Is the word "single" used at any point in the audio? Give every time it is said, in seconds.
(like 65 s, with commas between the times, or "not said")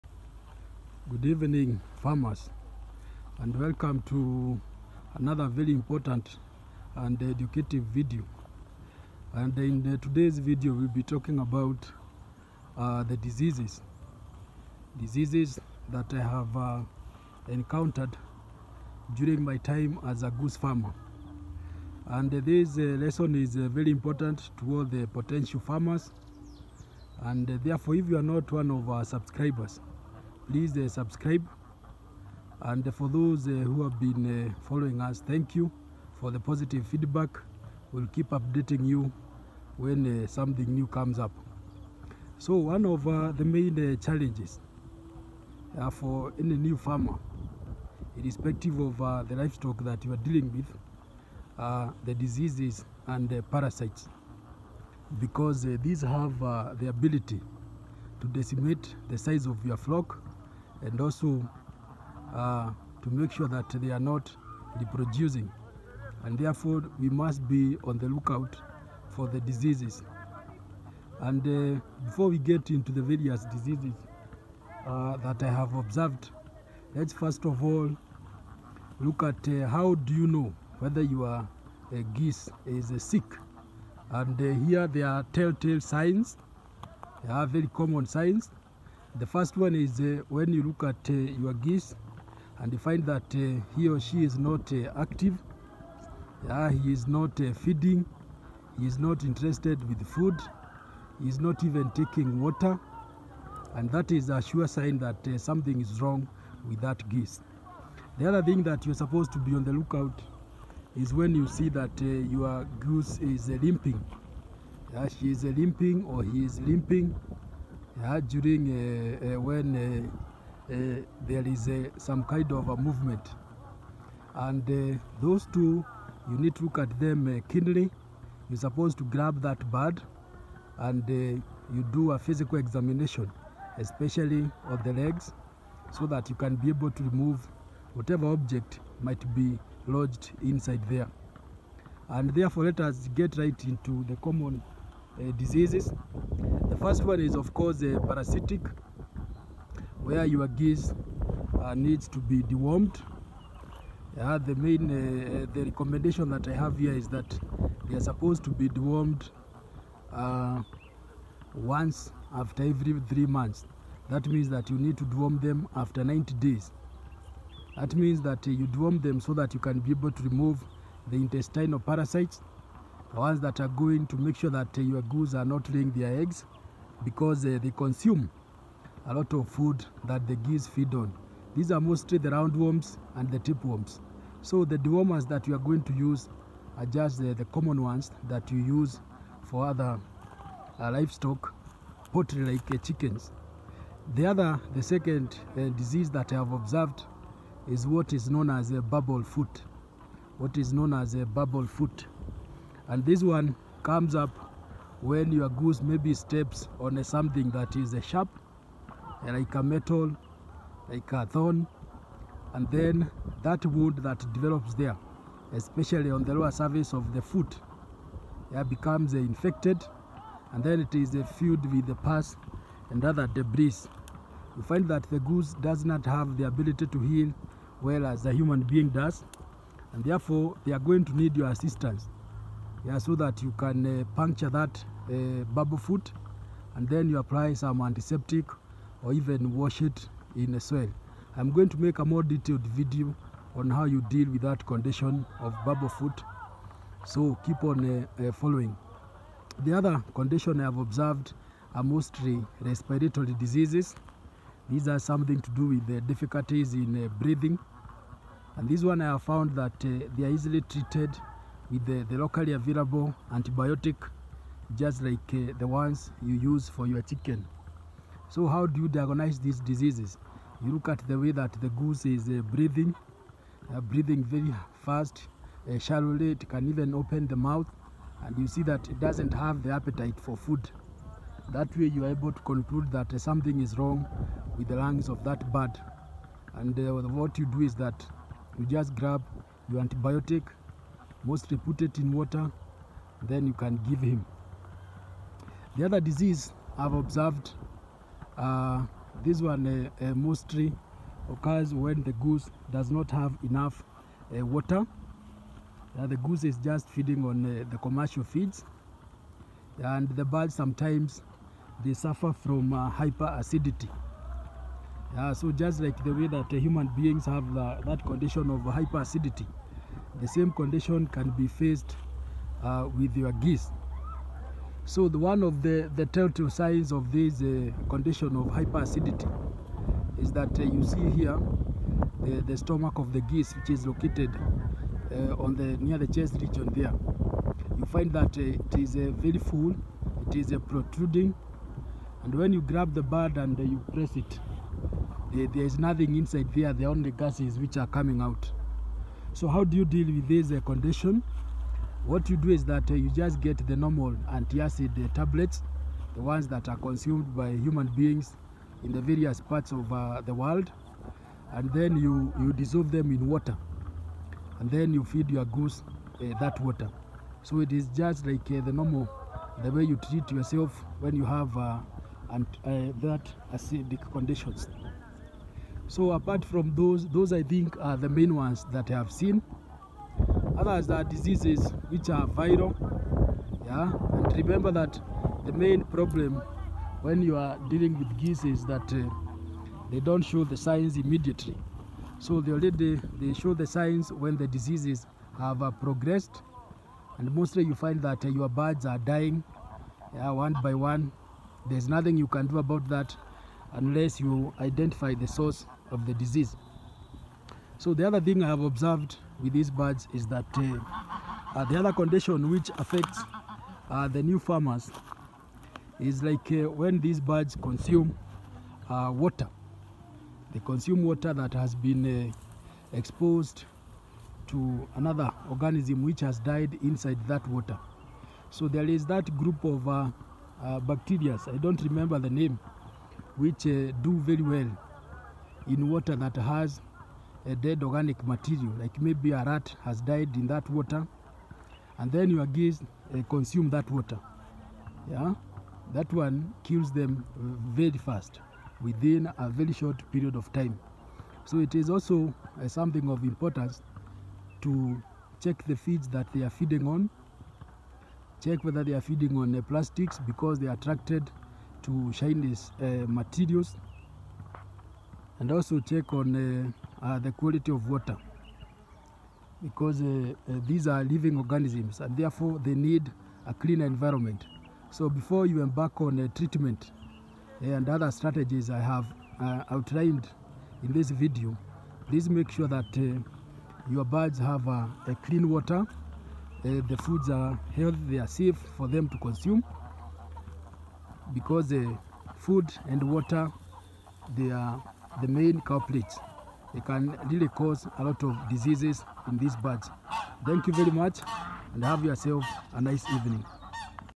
not said.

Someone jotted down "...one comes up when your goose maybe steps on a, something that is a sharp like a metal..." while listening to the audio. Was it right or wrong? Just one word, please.
right.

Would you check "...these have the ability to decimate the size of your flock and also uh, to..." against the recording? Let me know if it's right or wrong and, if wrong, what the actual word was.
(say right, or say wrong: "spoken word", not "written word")
right.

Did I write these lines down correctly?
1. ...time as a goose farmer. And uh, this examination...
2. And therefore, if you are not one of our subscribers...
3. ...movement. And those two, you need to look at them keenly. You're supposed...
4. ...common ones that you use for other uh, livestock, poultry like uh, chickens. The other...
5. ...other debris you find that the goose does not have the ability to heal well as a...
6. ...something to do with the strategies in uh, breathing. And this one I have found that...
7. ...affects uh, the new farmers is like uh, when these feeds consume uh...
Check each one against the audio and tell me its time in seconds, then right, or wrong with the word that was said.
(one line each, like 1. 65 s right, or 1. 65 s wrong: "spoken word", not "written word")
1. 19 s wrong: "lesson", not "examination"
2. 27 s right
3. 122 s right
4. 187 s right
5. 223 s right
6. 254 s wrong: "difficulties", not "strategies"
7. 412 s wrong: "birds", not "feeds".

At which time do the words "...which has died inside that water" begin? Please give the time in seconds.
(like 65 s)
426 s.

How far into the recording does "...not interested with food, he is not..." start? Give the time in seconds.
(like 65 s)
98 s.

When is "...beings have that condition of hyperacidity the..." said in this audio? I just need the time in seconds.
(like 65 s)
316 s.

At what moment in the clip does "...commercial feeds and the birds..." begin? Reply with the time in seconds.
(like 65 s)
307 s.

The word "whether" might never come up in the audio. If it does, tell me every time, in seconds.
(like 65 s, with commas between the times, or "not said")
80 s, 458 s.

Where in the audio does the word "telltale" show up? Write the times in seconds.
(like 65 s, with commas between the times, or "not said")
85 s, 326 s.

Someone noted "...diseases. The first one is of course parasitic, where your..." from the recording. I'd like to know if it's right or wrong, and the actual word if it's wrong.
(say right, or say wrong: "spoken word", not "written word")
right.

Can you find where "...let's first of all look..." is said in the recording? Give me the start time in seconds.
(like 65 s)
76 s.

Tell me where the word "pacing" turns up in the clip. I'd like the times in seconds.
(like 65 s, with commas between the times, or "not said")
not said.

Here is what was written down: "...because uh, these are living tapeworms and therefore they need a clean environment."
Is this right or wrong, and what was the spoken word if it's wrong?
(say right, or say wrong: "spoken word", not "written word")
wrong: "organisms", not "tapeworms".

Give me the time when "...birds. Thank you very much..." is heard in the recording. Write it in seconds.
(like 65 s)
499 s.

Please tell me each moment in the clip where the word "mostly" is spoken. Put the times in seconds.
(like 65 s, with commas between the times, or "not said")
181 s, 251 s, 291 s, 300 s, 397 s.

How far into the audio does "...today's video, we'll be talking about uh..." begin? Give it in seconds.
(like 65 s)
9 s.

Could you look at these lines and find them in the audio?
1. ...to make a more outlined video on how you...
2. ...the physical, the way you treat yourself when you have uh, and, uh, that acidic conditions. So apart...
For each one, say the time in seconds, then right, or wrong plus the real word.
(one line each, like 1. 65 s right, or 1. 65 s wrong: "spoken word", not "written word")
1. 241 s wrong: "detailed", not "outlined"
2. 368 s wrong: "normal", not "physical".